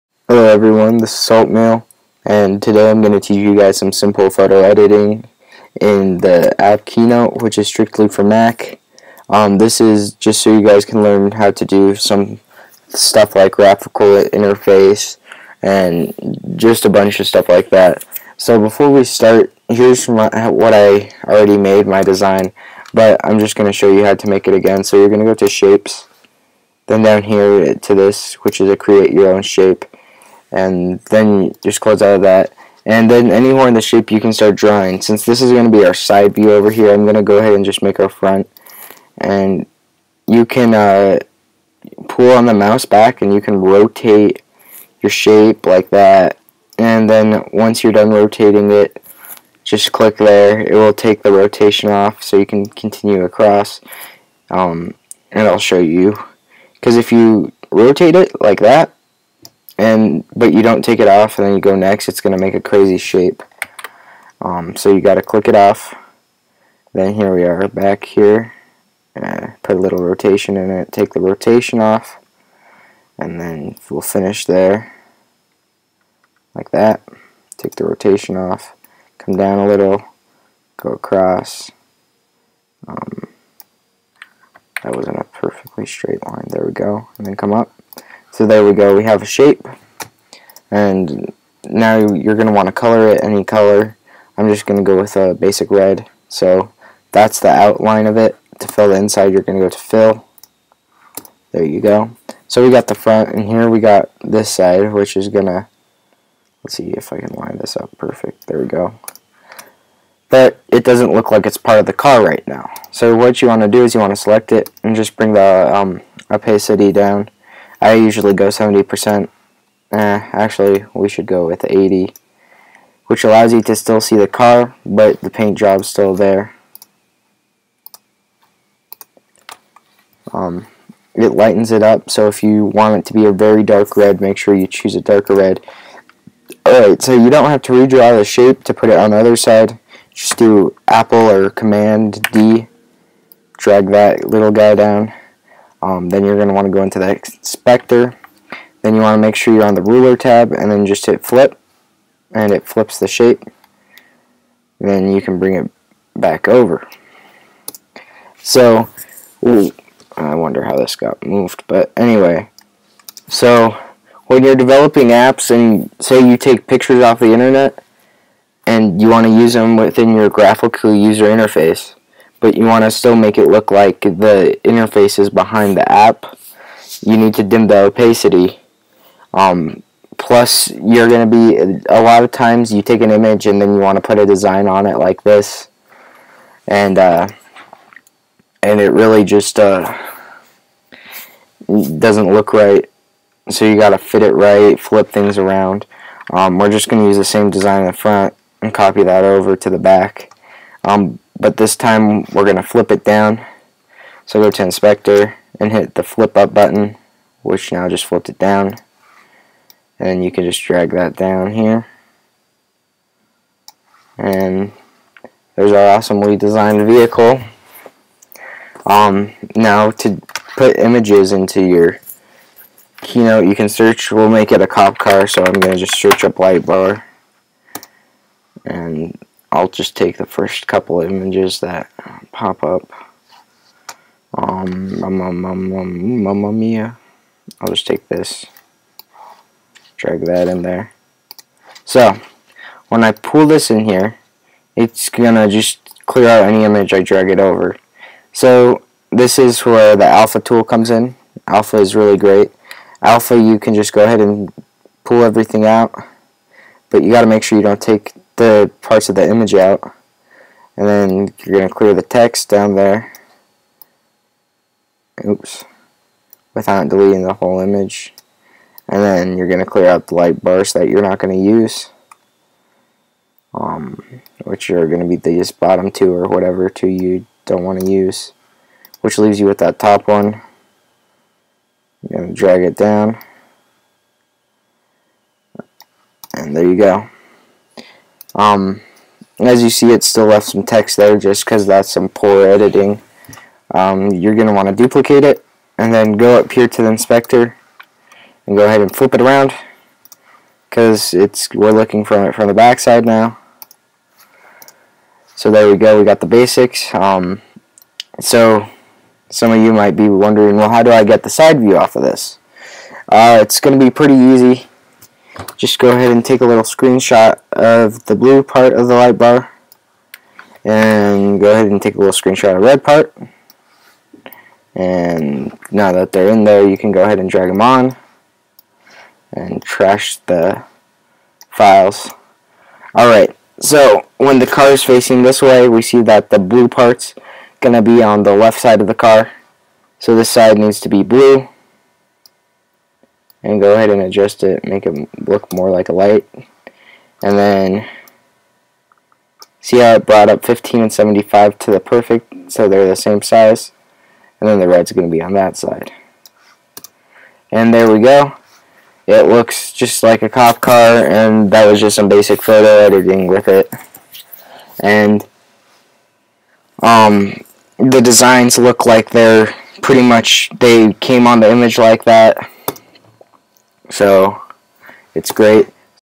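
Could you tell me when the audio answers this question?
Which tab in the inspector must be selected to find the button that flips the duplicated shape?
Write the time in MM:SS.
02:29.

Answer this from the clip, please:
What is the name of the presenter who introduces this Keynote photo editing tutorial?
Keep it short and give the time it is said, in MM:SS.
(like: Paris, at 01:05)
Salt, at 00:01.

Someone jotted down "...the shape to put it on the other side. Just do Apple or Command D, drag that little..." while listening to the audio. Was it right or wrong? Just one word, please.
right.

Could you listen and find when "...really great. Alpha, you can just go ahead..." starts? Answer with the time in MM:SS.
04:11.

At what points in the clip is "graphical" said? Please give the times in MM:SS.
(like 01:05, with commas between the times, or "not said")
00:13, 02:50.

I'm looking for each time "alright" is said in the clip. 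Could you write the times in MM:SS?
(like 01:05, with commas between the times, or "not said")
02:16, 05:32.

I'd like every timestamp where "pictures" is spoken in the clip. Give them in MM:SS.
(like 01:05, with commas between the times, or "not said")
02:46.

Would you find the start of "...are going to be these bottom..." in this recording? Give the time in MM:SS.
04:34.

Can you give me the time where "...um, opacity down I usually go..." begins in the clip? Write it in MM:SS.
01:55.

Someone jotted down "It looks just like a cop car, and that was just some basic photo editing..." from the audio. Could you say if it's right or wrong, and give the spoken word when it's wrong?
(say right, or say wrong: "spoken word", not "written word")
right.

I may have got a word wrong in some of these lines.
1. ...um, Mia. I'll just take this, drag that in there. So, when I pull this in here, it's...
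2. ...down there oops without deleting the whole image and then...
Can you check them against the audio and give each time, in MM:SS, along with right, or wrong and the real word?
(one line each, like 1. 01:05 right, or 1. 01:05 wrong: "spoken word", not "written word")
1. 03:56 right
2. 04:22 right.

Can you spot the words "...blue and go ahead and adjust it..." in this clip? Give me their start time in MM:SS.
05:41.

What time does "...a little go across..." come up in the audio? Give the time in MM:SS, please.
01:19.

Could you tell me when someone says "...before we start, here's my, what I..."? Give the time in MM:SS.
00:18.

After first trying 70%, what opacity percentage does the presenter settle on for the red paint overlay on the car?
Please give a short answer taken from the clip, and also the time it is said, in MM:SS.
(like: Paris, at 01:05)
80, at 02:01.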